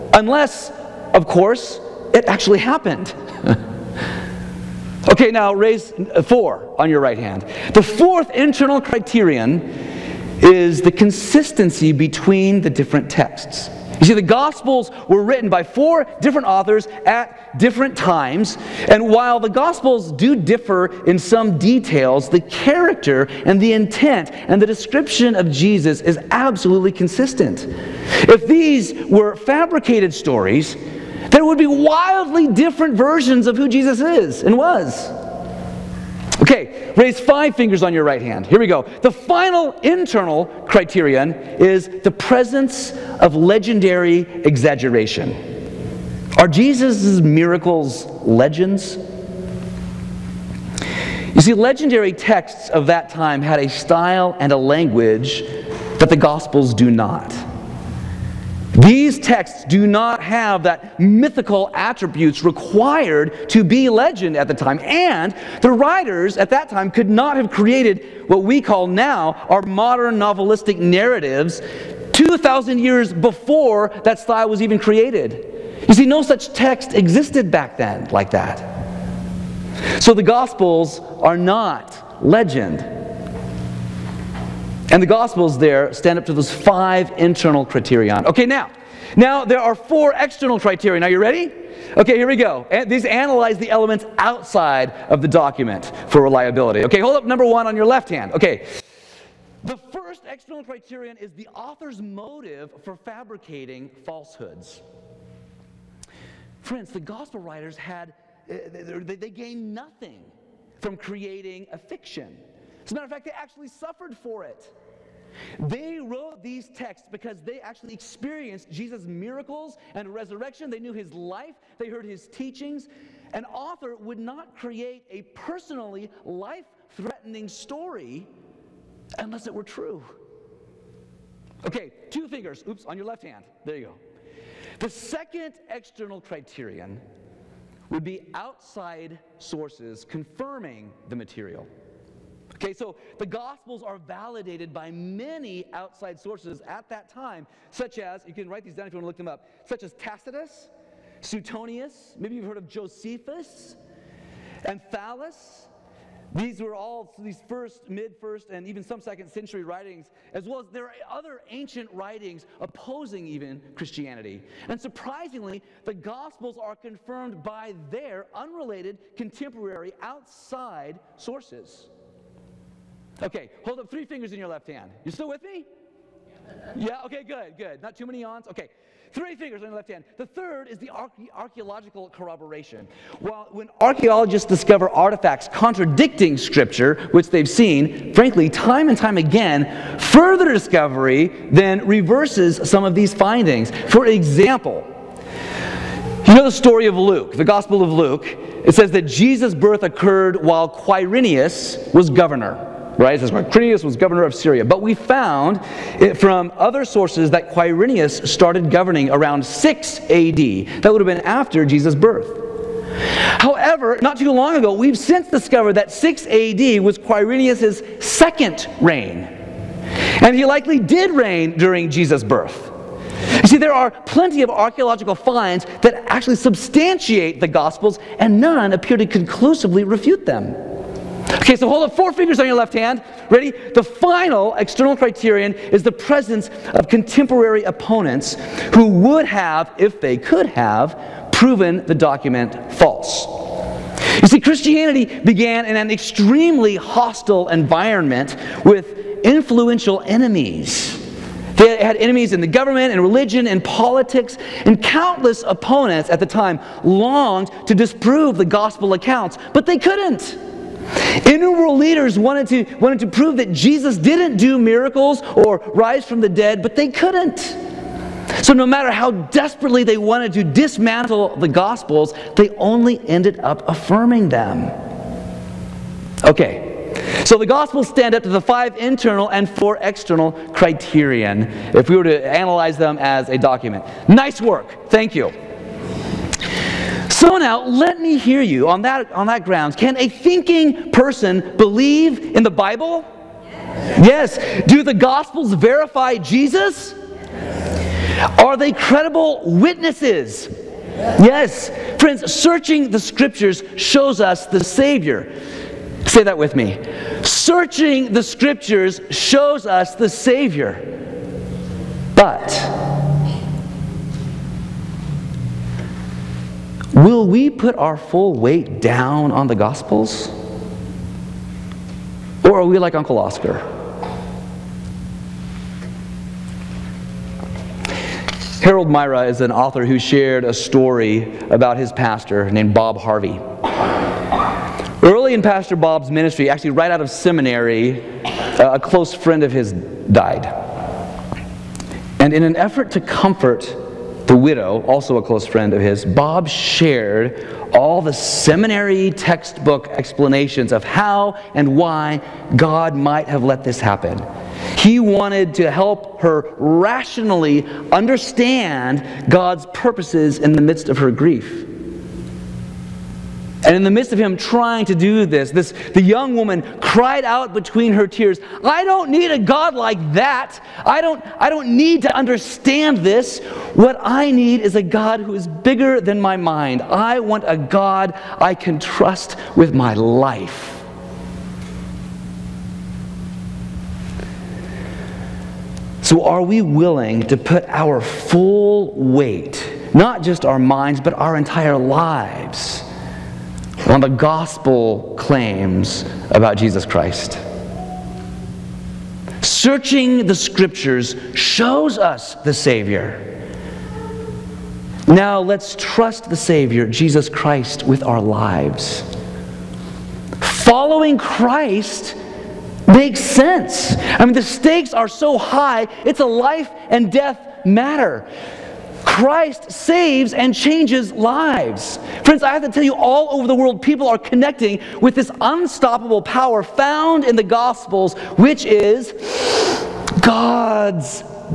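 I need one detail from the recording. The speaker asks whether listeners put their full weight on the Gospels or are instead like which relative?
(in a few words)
Uncle Oscar.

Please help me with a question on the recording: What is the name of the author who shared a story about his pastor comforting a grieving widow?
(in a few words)
Harold Myra.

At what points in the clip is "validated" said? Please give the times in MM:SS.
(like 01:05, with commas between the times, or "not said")
02:23.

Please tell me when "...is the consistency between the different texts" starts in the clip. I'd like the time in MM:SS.
00:10.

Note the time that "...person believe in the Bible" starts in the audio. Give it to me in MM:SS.
04:50.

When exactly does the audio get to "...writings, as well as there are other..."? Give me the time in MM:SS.
02:39.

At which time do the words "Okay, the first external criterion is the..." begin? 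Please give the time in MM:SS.
01:38.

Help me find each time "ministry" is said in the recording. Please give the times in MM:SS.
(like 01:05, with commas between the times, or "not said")
05:36.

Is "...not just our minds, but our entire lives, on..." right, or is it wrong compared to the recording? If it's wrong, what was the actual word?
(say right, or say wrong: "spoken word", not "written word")
right.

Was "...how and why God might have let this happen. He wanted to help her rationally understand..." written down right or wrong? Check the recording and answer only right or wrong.
right.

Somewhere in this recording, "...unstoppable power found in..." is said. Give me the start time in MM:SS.
07:05.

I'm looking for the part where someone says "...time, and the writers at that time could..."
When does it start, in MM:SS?
01:04.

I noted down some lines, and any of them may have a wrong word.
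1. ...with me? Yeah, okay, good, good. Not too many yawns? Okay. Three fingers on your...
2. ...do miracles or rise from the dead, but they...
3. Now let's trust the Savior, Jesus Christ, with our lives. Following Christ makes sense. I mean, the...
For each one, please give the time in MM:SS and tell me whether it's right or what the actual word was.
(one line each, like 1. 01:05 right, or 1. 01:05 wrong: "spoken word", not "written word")
1. 02:55 right
2. 04:24 right
3. 06:45 right.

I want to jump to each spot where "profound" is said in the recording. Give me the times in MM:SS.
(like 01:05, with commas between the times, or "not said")
not said.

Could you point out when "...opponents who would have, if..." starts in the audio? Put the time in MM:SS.
03:57.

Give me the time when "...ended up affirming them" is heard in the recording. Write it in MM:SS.
04:33.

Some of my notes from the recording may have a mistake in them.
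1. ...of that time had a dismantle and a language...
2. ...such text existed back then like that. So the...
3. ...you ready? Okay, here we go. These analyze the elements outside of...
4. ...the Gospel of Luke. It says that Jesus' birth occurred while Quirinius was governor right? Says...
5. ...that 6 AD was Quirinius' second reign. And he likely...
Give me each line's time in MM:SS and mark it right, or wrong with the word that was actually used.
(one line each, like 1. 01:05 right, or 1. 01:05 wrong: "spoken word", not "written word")
1. 00:52 wrong: "style", not "dismantle"
2. 01:16 right
3. 01:31 right
4. 03:17 right
5. 03:35 right.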